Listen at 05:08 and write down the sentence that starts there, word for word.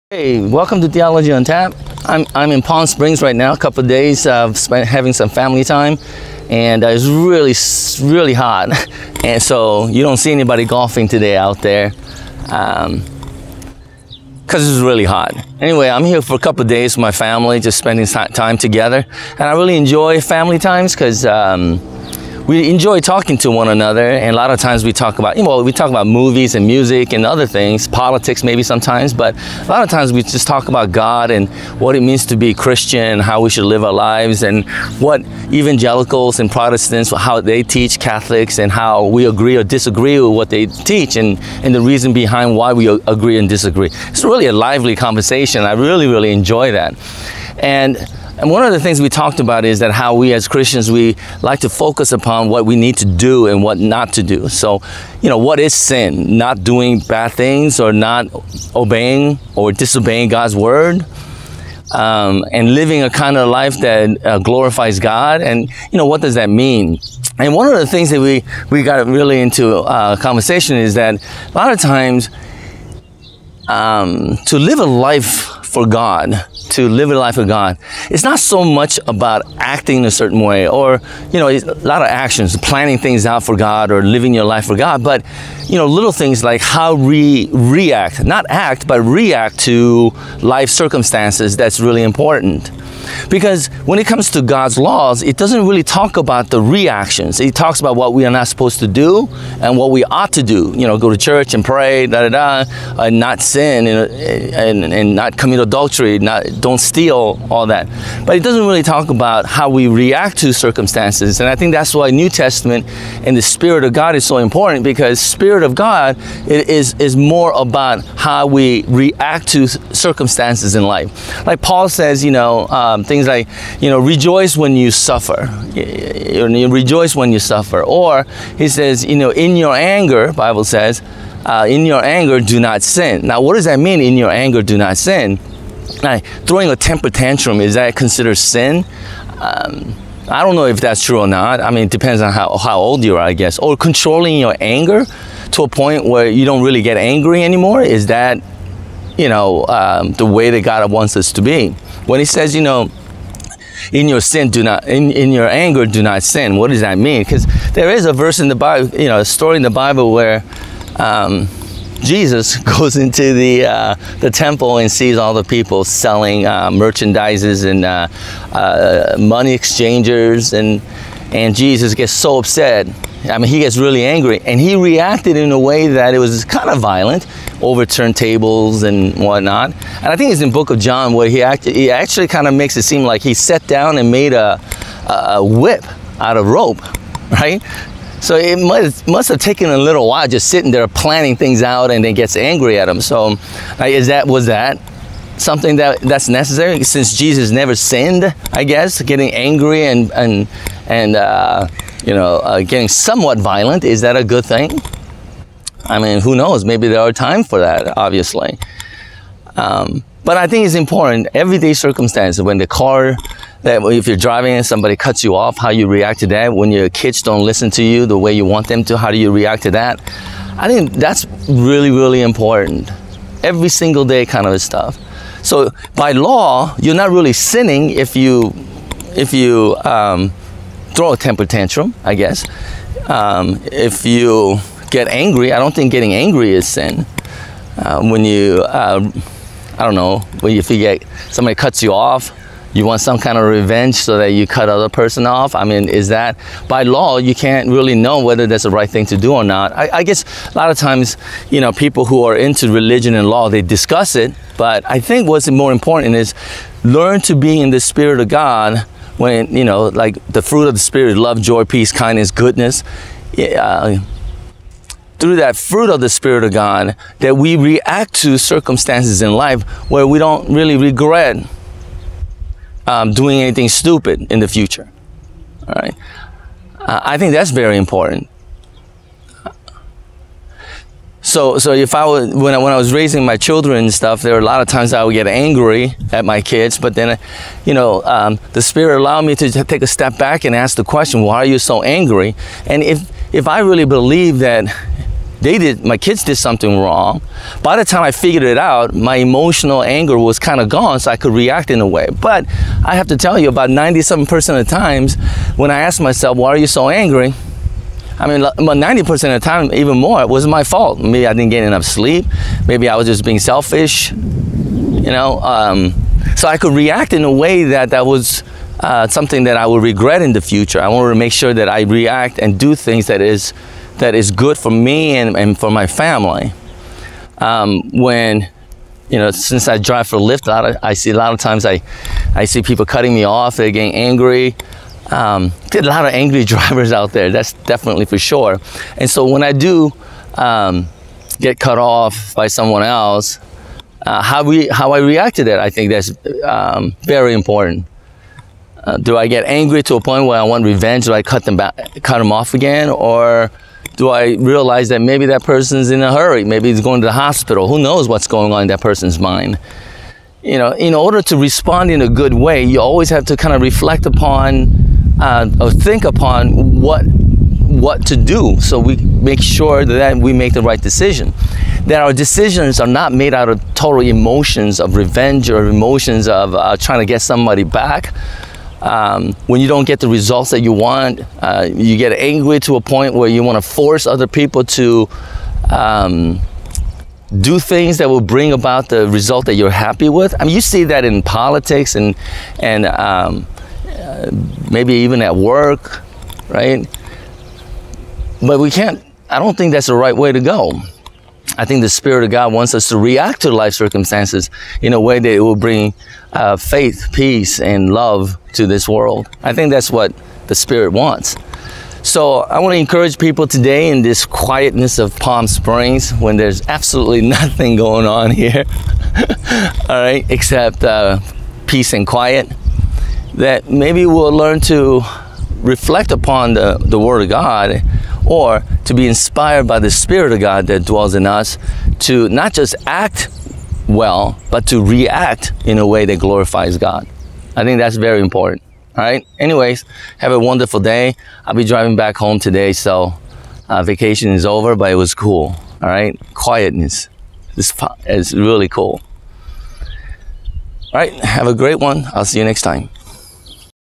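I mean, about 90% of the time, even more, it was my fault.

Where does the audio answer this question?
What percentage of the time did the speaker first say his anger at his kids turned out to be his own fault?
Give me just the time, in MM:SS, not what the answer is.
05:03.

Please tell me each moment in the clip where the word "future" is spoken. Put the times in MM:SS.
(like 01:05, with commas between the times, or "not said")
04:34, 05:20.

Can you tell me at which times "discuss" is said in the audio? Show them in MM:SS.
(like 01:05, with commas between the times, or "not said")
04:13.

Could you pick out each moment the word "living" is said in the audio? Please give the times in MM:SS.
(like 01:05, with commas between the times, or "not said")
01:02, 01:24.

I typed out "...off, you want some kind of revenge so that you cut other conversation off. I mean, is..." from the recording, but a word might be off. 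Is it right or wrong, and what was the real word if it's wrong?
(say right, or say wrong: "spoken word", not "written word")
wrong: "person", not "conversation".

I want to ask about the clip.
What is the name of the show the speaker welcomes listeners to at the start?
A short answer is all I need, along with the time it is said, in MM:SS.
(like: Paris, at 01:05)
Theology on Tap, at 00:00.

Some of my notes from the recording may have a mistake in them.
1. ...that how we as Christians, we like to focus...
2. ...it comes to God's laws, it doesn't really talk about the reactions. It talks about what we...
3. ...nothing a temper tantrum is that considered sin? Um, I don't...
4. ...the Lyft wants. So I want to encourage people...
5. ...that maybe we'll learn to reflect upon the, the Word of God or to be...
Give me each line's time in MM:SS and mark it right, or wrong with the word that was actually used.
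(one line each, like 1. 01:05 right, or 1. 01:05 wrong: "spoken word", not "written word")
1. 00:49 right
2. 01:33 right
3. 02:16 wrong: "throwing", not "nothing"
4. 06:50 wrong: "Spirit", not "Lyft"
5. 07:03 right.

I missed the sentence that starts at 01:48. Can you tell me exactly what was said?
But it doesn't really talk about how we react to circumstances.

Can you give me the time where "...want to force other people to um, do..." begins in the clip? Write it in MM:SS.
06:23.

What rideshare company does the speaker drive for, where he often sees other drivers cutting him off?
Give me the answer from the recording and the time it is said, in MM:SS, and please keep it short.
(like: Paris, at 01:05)
Lyft, at 05:30.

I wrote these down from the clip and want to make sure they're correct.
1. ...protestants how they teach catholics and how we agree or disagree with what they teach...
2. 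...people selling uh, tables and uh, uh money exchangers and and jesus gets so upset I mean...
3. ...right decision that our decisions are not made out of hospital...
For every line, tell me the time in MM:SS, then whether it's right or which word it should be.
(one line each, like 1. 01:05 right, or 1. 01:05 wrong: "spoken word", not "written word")
1. 00:36 right
2. 02:45 wrong: "merchandises", not "tables"
3. 06:10 wrong: "total", not "hospital".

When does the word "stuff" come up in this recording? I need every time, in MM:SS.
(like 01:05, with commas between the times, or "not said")
03:44, 04:43.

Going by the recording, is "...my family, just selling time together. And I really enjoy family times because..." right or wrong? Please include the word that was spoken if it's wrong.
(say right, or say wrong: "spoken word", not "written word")
wrong: "spending", not "selling".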